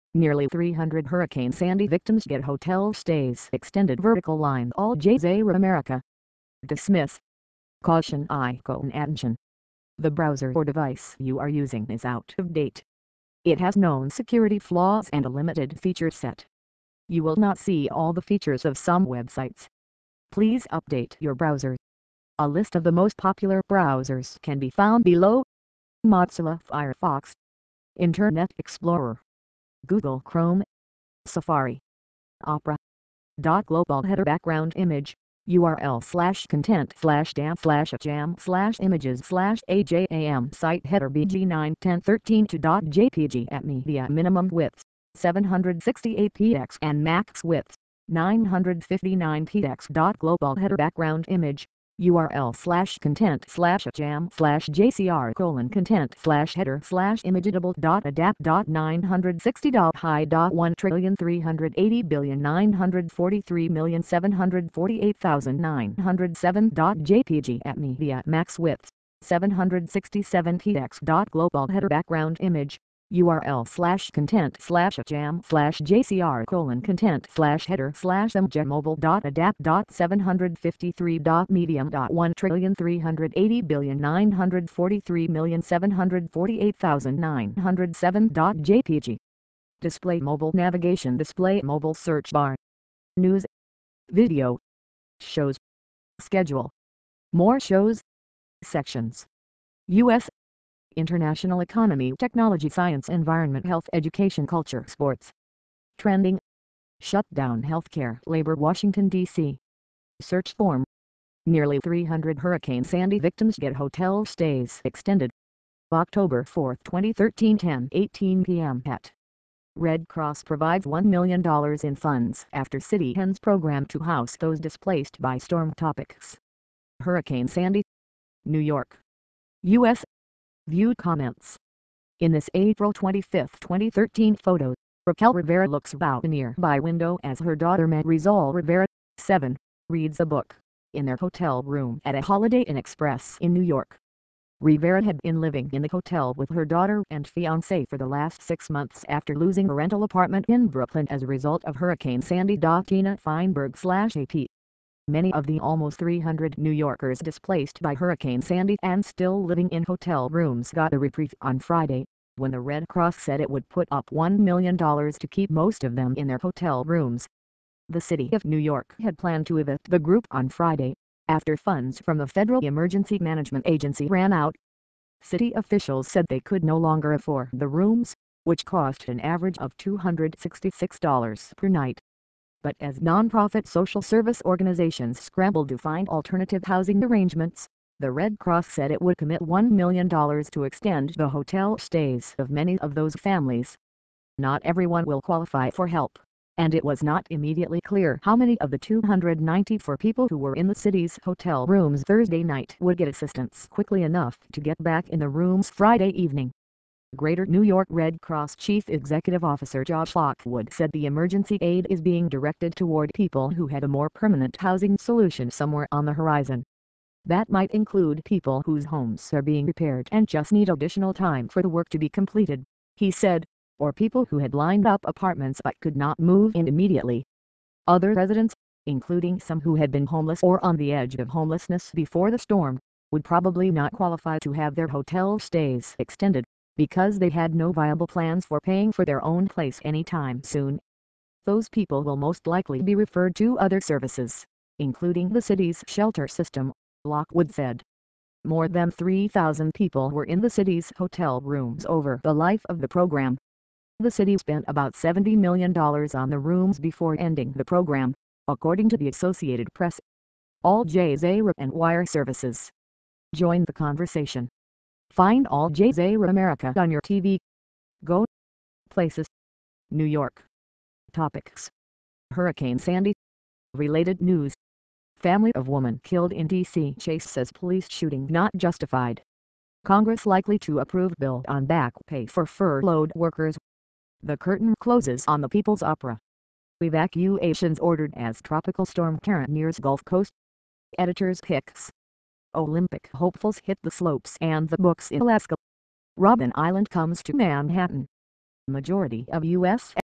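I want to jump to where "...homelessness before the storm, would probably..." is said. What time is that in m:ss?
3:51.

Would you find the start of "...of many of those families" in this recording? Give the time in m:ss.
3:12.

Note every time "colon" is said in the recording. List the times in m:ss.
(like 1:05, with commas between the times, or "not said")
0:55, 1:16.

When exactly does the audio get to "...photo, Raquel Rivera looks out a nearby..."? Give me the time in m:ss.
2:14.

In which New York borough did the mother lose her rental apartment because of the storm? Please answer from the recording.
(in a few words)
Brooklyn.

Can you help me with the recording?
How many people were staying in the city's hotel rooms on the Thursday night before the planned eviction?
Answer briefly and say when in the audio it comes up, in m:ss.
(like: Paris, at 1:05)
294, at 3:18.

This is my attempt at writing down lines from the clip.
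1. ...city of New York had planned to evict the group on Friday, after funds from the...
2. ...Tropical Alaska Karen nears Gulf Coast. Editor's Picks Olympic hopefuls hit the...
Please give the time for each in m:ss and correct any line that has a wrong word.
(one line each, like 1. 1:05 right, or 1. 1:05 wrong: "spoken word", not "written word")
1. 2:47 right
2. 4:48 wrong: "Storm", not "Alaska".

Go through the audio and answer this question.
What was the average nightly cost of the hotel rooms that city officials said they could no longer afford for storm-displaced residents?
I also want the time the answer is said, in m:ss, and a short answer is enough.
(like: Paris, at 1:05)
$266, at 2:59.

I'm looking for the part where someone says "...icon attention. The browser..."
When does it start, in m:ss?
0:08.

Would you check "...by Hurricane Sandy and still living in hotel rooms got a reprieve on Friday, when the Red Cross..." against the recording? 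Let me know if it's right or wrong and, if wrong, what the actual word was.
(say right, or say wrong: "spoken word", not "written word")
right.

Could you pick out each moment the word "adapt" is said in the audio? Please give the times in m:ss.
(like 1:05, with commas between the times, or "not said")
0:58, 1:19.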